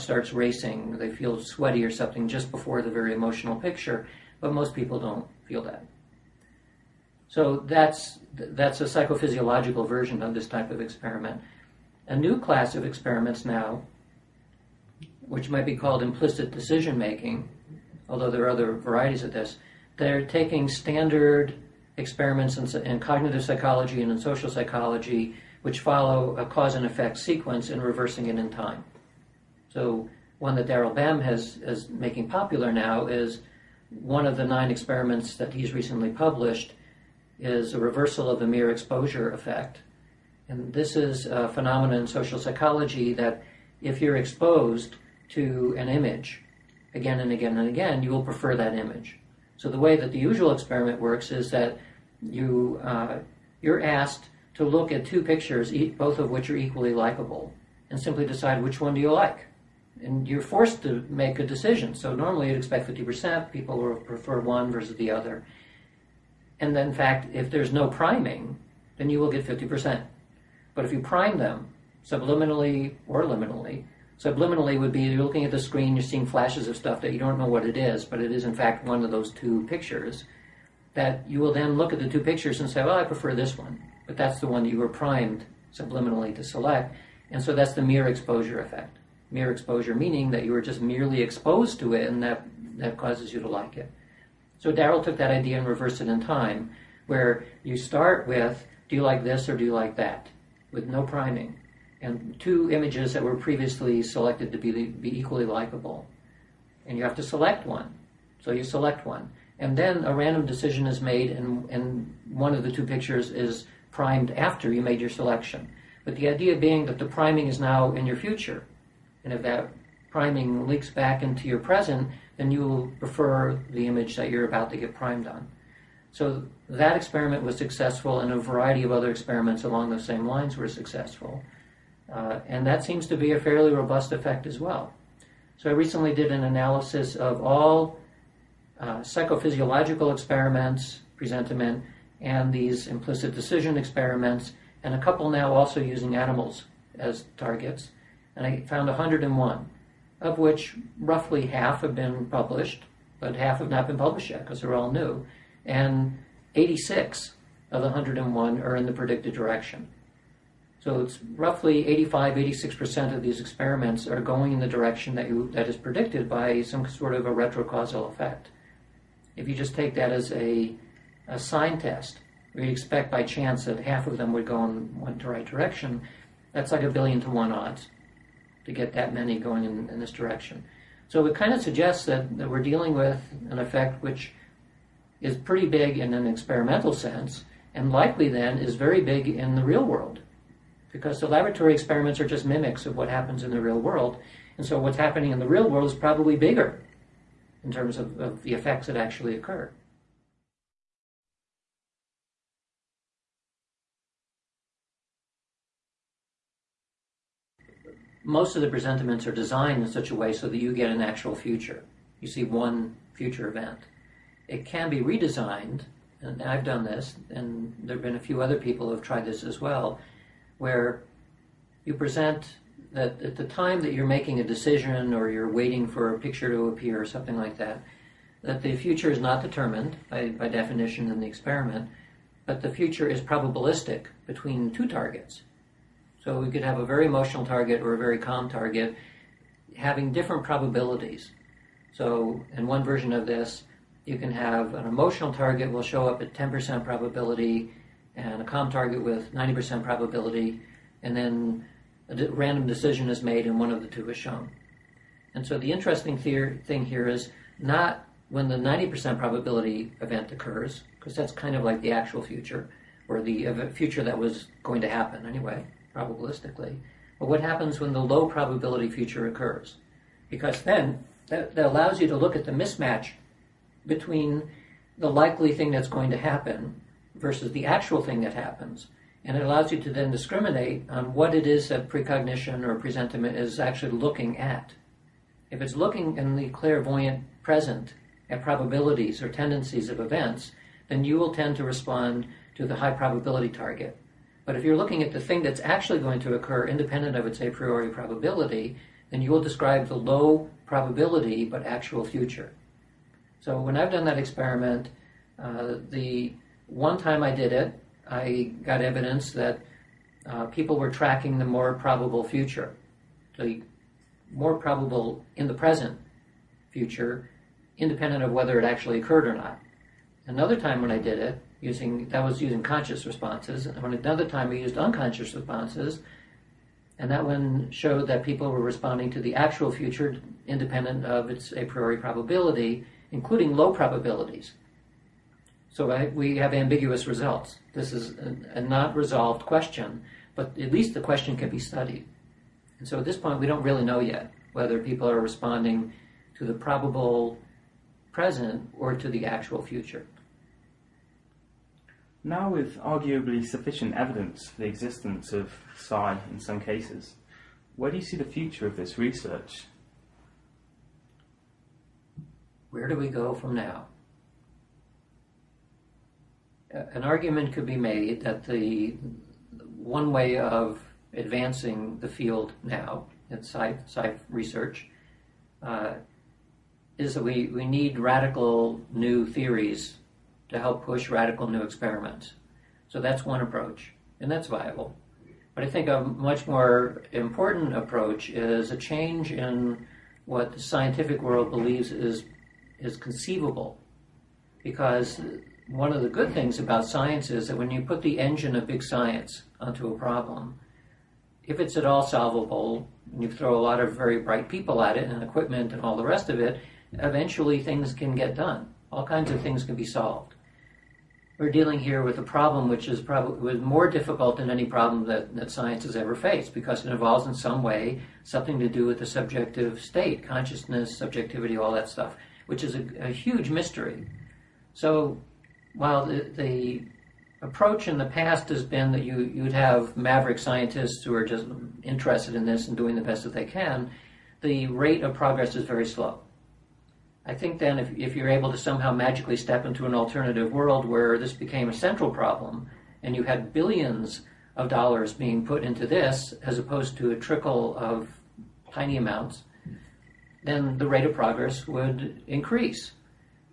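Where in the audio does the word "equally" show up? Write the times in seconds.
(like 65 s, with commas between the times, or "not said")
56 s, 105 s.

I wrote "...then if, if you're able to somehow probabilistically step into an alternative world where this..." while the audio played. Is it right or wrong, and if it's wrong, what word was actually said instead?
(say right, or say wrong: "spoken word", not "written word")
wrong: "magically", not "probabilistically".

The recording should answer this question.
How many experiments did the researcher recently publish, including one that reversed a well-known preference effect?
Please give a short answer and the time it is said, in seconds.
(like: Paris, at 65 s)
9, at 34 s.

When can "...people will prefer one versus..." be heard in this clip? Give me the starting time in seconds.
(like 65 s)
63 s.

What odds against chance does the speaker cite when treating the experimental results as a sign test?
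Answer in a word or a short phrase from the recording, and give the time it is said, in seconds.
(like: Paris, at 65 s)
a billion to one, at 176 s.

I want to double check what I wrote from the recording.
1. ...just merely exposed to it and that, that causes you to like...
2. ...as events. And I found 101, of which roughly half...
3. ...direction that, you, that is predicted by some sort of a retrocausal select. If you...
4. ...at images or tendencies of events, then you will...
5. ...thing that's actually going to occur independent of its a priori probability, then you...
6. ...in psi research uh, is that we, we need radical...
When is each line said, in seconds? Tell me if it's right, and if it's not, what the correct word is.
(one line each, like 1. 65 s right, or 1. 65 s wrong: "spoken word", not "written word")
1. 90 s right
2. 146 s wrong: "targets", not "events"
3. 164 s wrong: "effect", not "select"
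4. 288 s wrong: "probabilities", not "images"
5. 295 s right
6. 373 s right.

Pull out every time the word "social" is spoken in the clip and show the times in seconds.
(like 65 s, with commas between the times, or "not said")
24 s, 42 s.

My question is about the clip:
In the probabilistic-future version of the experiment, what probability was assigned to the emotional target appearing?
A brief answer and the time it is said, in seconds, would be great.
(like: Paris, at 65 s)
10%, at 246 s.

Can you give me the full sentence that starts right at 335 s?
So I, we have ambiguous results.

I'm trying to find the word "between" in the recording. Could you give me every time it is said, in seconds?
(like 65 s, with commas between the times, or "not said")
234 s, 273 s.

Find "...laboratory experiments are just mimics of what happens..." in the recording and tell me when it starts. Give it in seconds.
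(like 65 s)
191 s.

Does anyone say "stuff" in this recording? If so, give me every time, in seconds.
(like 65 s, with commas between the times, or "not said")
76 s, 421 s.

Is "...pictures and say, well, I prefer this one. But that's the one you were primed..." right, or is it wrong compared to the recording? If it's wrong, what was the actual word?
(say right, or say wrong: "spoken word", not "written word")
right.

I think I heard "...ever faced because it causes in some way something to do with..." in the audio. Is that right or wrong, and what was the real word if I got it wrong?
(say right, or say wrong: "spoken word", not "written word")
wrong: "involves", not "causes".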